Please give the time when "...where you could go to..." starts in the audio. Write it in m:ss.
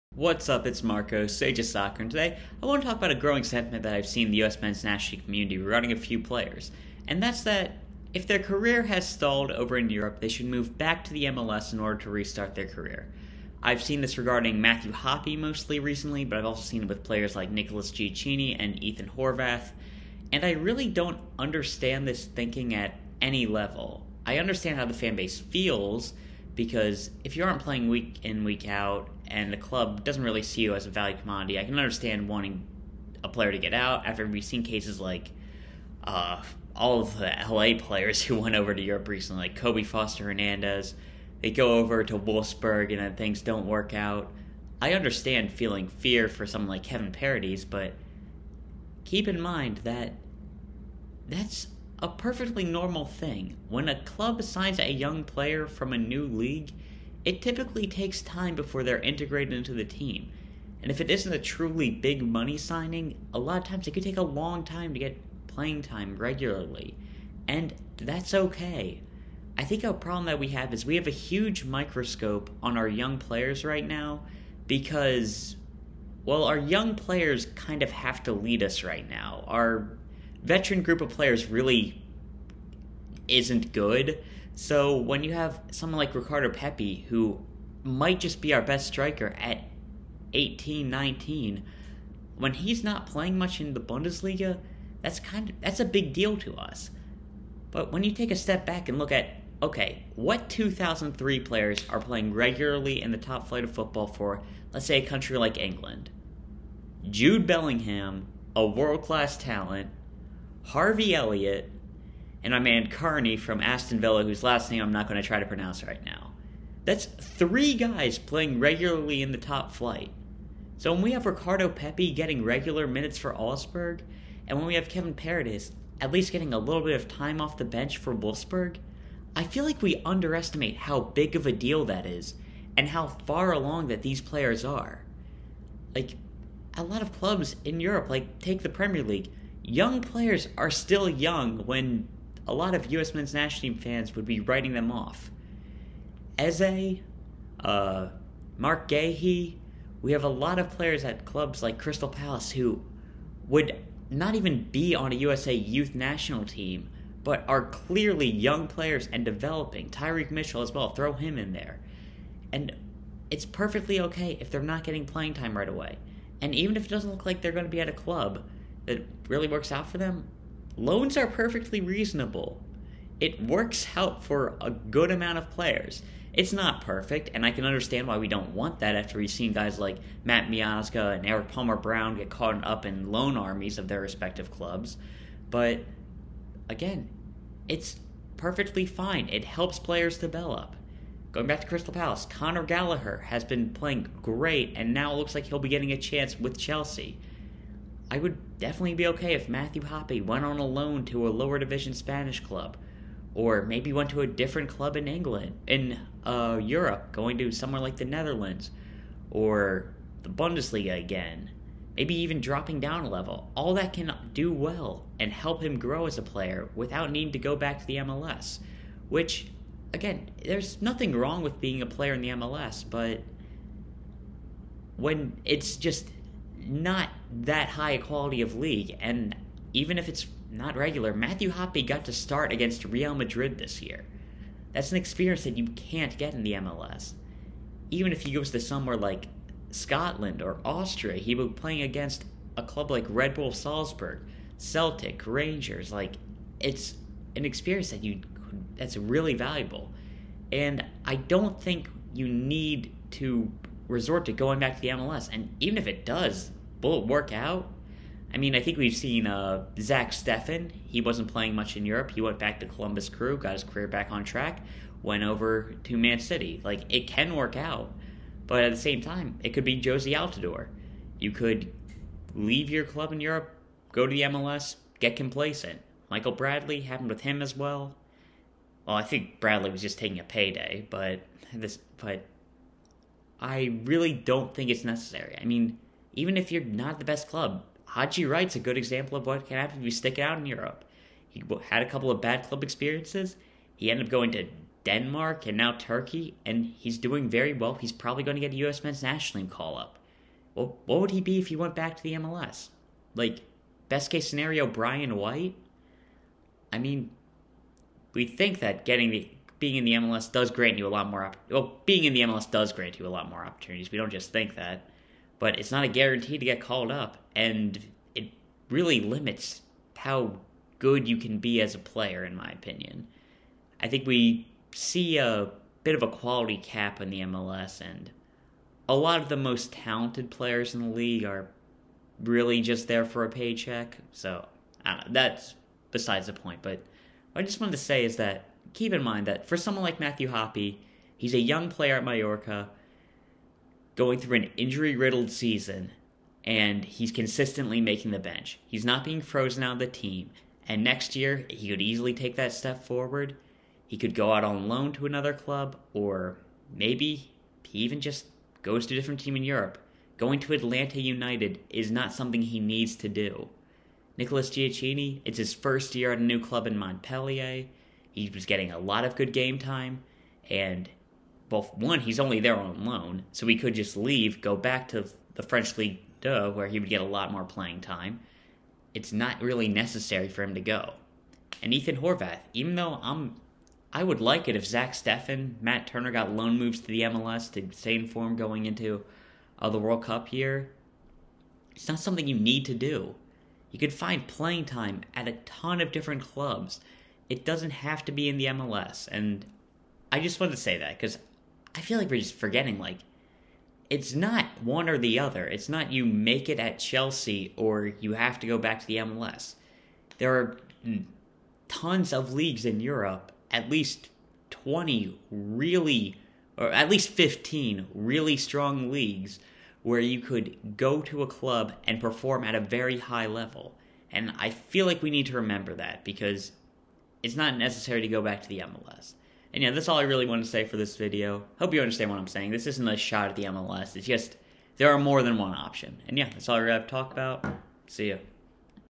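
6:59.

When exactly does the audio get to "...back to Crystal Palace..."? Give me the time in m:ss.
3:11.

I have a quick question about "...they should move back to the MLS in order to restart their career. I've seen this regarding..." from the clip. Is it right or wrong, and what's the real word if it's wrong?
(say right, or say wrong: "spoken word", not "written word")
right.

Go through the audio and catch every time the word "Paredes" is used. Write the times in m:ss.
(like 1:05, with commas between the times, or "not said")
0:47, 2:05.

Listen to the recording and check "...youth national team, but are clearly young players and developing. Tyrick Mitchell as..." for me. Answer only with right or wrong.
right.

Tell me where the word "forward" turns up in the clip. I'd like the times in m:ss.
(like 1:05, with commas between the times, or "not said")
5:52.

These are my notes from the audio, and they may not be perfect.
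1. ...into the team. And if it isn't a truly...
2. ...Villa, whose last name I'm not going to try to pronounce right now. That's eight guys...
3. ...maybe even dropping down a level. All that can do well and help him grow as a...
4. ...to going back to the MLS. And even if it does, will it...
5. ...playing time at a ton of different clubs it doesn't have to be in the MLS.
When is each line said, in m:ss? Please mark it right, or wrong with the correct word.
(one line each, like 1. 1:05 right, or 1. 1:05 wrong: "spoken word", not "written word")
1. 0:59 right
2. 1:53 wrong: "three", not "eight"
3. 3:31 right
4. 4:14 right
5. 6:34 right.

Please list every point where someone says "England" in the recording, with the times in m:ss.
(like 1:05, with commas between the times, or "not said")
1:45, 3:25.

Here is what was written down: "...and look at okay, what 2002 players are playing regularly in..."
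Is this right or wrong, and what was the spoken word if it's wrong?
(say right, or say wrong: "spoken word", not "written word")
wrong: "2003", not "2002".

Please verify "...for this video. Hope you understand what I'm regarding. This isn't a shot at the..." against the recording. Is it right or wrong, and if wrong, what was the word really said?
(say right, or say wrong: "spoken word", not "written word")
wrong: "saying", not "regarding".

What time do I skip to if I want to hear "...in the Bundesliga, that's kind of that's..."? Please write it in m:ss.
1:33.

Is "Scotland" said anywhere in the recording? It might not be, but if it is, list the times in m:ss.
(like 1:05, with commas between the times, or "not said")
3:59.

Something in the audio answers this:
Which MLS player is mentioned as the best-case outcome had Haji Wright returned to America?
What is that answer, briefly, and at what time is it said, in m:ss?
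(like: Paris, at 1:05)
Brian White, at 5:04.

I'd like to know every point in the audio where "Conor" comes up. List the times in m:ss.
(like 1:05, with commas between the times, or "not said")
3:12.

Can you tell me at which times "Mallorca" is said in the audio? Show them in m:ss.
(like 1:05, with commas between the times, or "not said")
5:42.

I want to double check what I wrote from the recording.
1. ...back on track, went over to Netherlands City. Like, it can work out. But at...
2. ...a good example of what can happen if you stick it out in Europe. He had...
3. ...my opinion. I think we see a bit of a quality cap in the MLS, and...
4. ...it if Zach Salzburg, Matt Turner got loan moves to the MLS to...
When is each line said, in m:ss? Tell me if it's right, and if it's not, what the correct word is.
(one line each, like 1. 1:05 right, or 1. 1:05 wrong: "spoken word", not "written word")
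1. 4:23 wrong: "Man", not "Netherlands"
2. 4:48 right
3. 5:22 right
4. 6:24 wrong: "Steffen", not "Salzburg".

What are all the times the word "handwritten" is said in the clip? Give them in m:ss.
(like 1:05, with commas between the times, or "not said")
not said.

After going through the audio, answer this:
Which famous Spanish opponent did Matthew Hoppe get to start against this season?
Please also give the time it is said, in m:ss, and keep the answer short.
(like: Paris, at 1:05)
Real Madrid, at 3:52.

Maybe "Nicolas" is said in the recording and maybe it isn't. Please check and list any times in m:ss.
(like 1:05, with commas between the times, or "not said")
0:17, 6:04.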